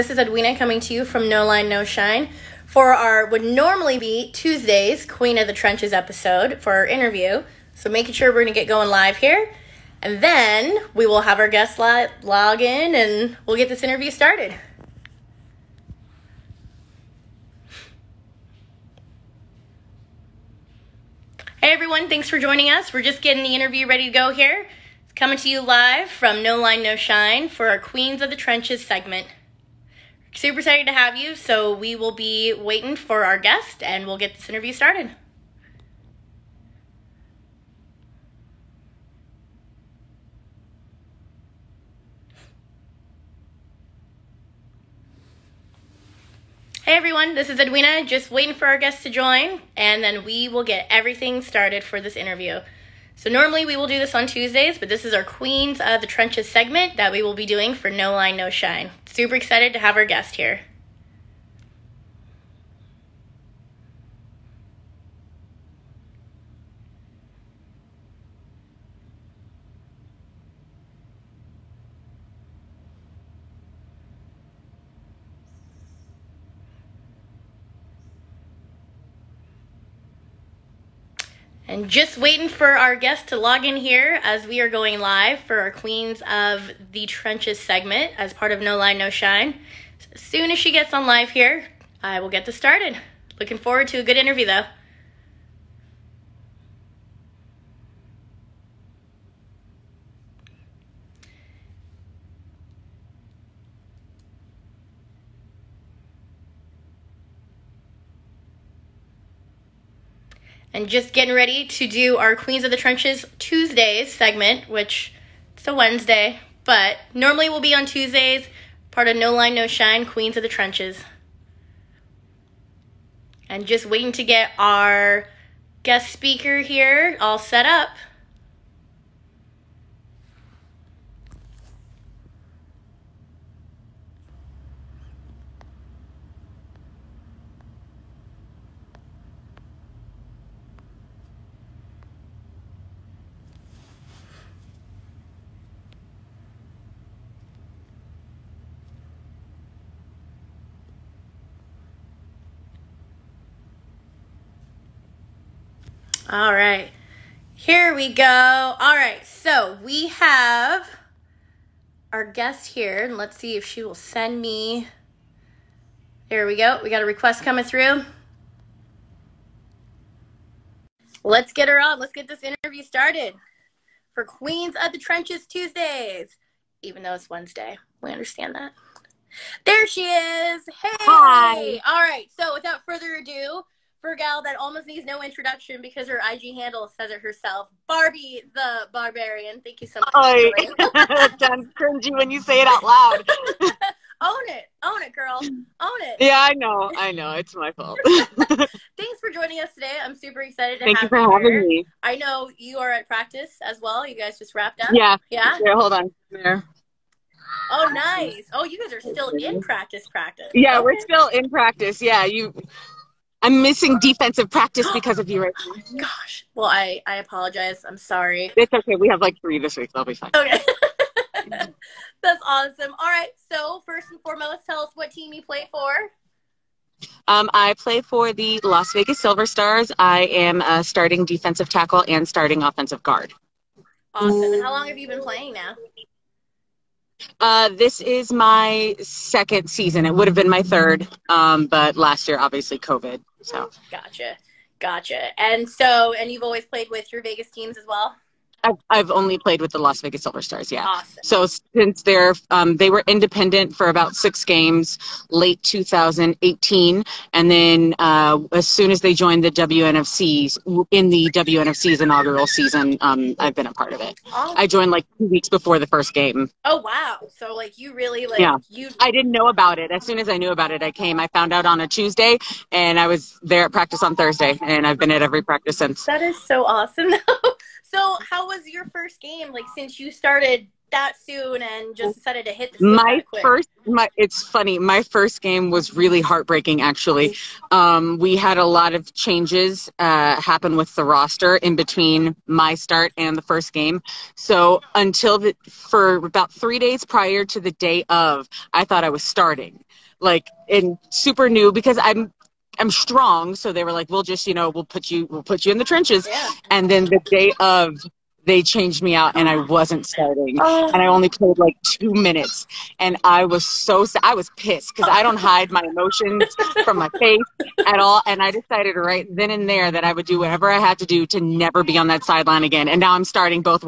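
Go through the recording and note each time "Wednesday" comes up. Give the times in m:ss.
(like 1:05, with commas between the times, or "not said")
1:55, 2:57.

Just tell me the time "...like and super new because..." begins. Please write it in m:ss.
5:00.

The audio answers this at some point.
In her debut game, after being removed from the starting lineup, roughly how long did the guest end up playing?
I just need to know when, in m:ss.
5:11.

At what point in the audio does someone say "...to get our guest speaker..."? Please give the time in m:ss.
2:04.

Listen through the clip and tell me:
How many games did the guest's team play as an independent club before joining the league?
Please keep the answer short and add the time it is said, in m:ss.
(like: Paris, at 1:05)
6, at 4:14.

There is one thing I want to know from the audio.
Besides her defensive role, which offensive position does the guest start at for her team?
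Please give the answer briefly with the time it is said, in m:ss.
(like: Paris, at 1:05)
Offensive guard, at 3:52.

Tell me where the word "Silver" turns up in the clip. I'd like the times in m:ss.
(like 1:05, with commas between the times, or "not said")
3:49, 4:10.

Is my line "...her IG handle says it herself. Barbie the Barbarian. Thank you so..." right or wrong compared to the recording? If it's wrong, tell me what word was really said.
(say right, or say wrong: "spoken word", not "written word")
right.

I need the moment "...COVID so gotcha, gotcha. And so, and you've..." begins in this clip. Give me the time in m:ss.
4:02.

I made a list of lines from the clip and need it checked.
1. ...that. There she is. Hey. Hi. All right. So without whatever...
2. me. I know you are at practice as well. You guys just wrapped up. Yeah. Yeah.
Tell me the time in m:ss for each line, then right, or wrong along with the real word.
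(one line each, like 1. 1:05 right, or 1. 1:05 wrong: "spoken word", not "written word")
1. 2:58 wrong: "further", not "whatever"
2. 3:21 right.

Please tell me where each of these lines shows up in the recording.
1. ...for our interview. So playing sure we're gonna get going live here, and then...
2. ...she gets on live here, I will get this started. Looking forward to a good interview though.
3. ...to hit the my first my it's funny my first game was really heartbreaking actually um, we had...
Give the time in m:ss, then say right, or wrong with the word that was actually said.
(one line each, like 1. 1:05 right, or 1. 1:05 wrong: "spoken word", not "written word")
1. 0:06 wrong: "making", not "playing"
2. 1:30 right
3. 4:42 right.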